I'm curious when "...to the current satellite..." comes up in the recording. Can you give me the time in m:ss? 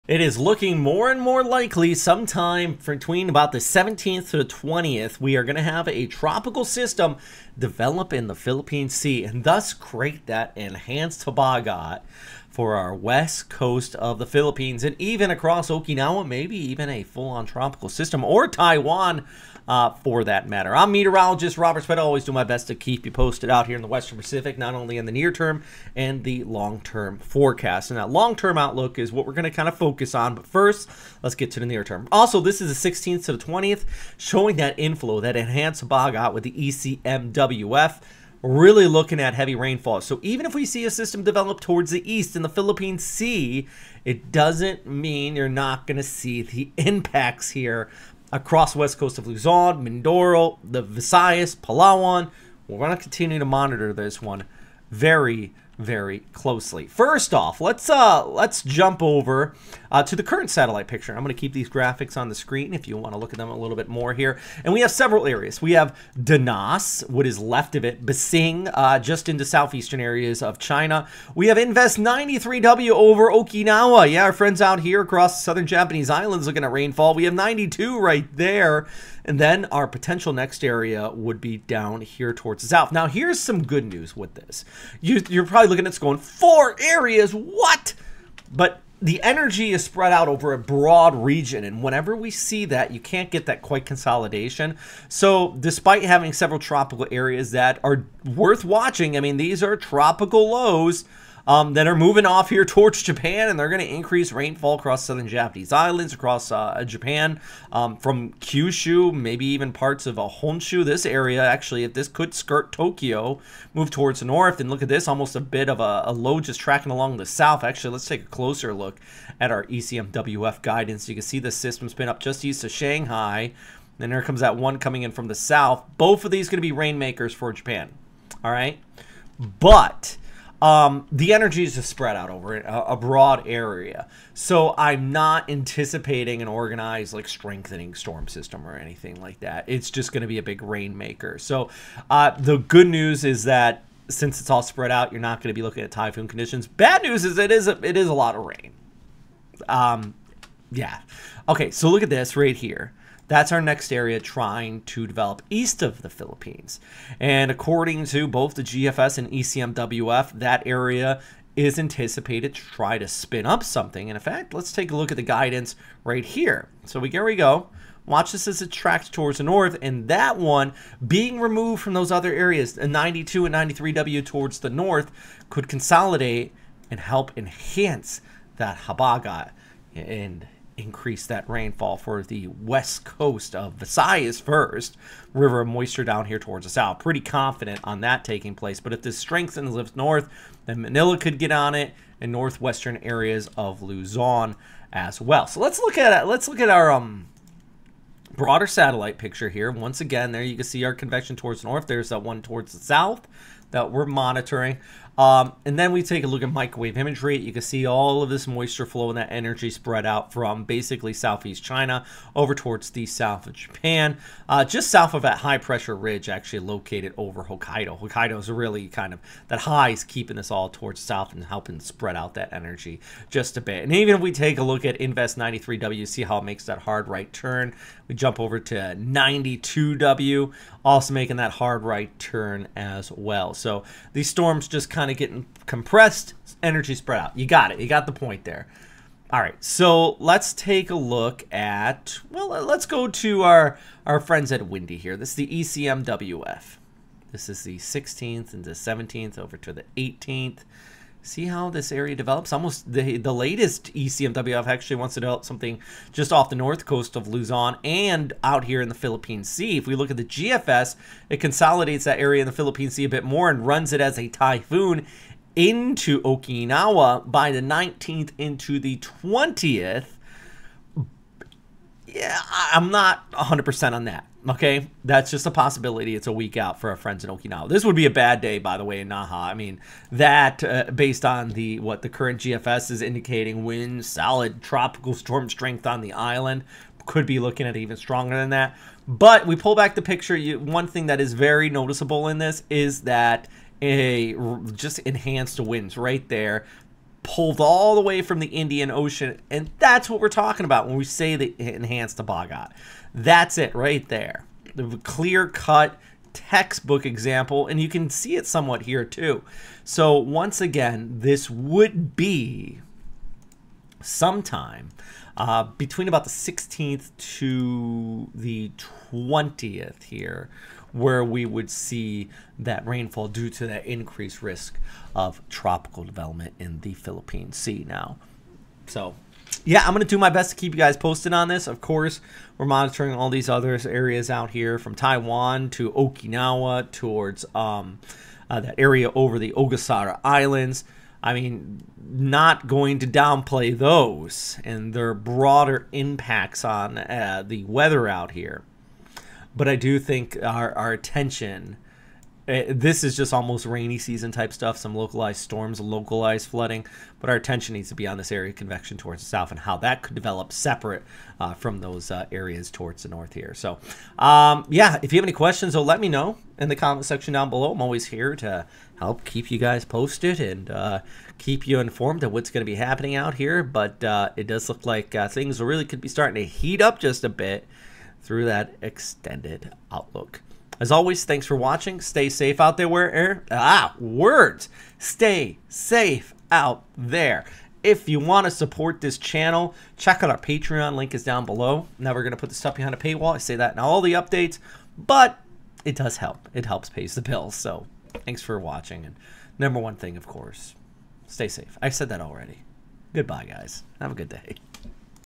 1:00.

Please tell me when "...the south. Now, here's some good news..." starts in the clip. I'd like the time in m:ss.
1:22.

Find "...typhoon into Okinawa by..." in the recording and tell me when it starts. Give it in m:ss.
4:24.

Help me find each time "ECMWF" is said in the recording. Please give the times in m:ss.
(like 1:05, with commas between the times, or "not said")
0:36, 1:59, 2:39, 4:05, 4:13.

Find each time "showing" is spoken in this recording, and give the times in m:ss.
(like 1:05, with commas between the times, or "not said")
0:34.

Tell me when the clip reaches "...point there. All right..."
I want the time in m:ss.
3:58.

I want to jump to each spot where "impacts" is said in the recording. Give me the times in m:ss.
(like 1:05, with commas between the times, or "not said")
0:46, 5:45.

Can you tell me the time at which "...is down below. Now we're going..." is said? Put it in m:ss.
6:31.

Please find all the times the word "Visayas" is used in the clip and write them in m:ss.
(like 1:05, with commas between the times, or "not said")
0:50, 3:03.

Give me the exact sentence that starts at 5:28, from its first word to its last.
So, yeah, I'm going to do my best to keep you guys posted on this.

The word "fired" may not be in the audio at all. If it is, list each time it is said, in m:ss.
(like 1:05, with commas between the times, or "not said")
not said.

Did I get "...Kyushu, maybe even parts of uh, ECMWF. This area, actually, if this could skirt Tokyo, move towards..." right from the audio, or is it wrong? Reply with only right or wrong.
wrong.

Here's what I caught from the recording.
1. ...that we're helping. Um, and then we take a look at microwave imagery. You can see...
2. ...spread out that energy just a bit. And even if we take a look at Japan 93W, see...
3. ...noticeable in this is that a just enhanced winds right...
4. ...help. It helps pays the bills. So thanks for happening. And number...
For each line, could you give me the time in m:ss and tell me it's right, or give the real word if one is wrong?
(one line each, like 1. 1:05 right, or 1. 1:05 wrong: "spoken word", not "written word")
1. 3:23 wrong: "monitoring", not "helping"
2. 3:41 wrong: "Invest", not "Japan"
3. 4:51 right
4. 6:36 wrong: "watching", not "happening".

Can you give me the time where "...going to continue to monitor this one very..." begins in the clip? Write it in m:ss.
0:52.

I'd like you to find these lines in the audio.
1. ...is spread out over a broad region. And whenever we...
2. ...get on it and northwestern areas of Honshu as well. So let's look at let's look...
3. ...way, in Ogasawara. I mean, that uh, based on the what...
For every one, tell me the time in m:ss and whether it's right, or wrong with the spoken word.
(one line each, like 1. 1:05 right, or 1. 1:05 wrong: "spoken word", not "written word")
1. 1:29 right
2. 3:11 wrong: "Luzon", not "Honshu"
3. 4:38 wrong: "Naha", not "Ogasawara".